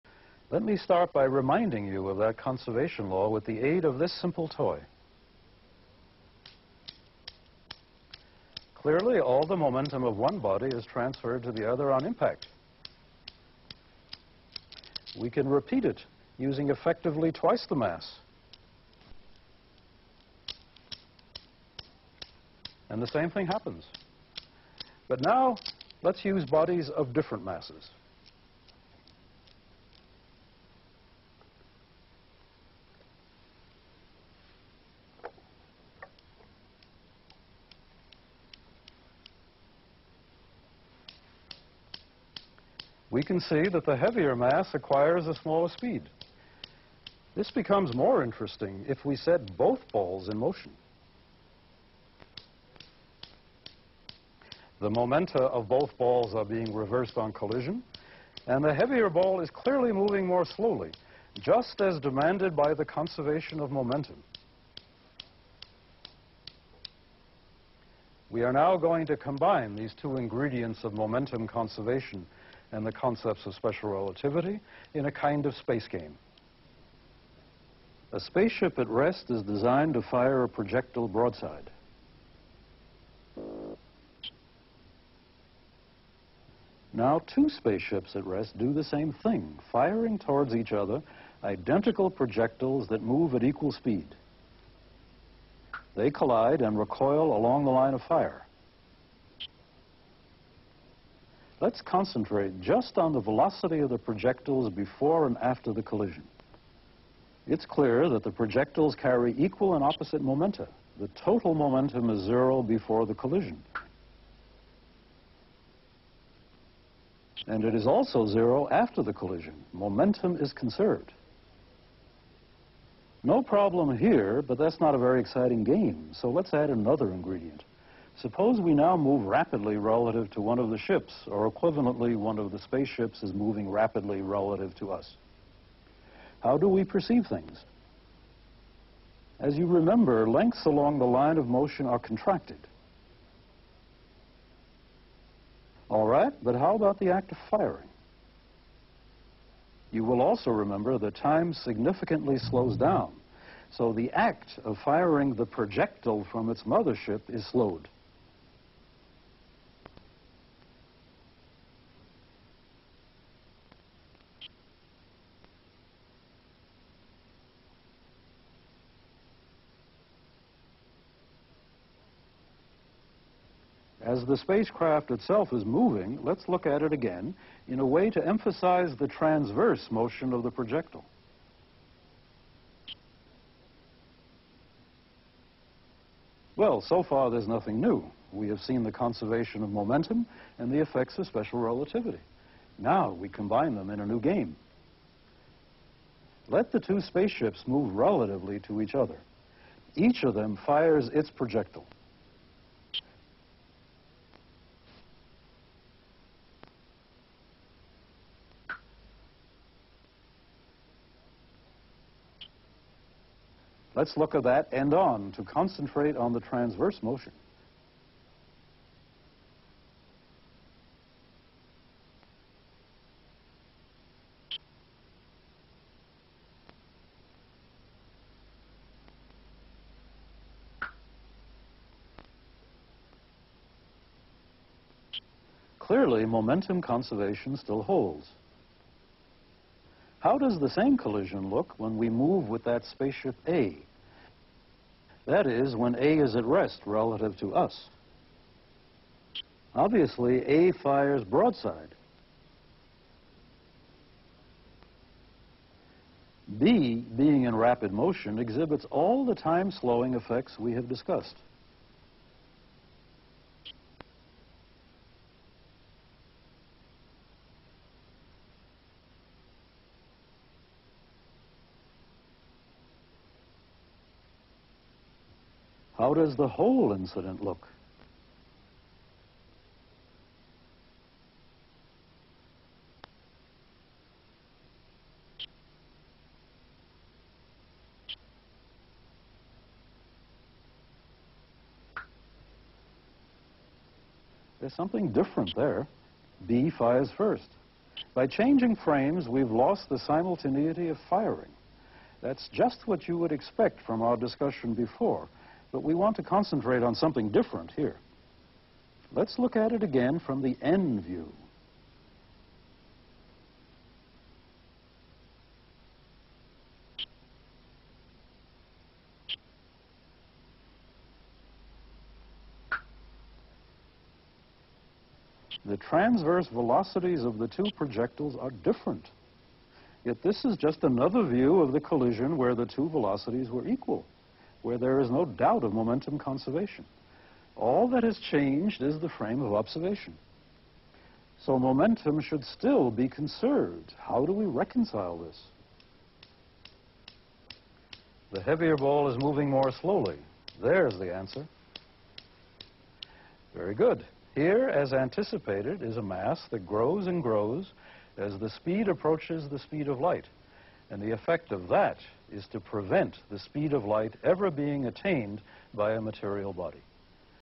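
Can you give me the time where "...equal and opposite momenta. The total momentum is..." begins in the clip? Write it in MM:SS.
01:49.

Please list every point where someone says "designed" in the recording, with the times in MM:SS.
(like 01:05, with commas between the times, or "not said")
01:19.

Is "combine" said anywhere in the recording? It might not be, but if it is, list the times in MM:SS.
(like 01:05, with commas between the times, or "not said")
01:09, 03:13.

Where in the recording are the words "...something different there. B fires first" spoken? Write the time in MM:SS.
04:54.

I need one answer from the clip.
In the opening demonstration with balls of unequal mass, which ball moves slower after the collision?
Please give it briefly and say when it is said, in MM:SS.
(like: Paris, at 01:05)
The heavier mass, at 00:43.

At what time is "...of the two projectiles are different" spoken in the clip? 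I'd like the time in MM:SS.
05:27.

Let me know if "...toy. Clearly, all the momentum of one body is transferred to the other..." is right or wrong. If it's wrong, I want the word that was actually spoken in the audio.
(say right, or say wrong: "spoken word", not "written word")
right.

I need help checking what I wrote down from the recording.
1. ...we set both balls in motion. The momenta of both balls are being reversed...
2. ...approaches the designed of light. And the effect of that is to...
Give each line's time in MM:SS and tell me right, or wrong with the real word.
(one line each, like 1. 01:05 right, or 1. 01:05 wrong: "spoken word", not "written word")
1. 00:49 right
2. 05:58 wrong: "speed", not "designed".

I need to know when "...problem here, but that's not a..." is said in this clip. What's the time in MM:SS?
02:03.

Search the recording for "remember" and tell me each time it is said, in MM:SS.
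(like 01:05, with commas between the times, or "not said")
02:19, 02:30.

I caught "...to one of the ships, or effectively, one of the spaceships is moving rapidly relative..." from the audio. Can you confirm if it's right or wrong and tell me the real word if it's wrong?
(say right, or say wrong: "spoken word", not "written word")
wrong: "equivalently", not "effectively".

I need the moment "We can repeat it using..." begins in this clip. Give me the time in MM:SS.
00:15.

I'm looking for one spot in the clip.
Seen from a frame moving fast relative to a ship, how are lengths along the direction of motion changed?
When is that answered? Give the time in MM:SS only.
02:21.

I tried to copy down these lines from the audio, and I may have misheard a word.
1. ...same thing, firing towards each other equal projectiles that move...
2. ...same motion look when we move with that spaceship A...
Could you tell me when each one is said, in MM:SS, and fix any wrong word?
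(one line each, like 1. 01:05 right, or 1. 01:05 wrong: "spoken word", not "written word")
1. 01:28 wrong: "identical", not "equal"
2. 04:00 wrong: "collision", not "motion".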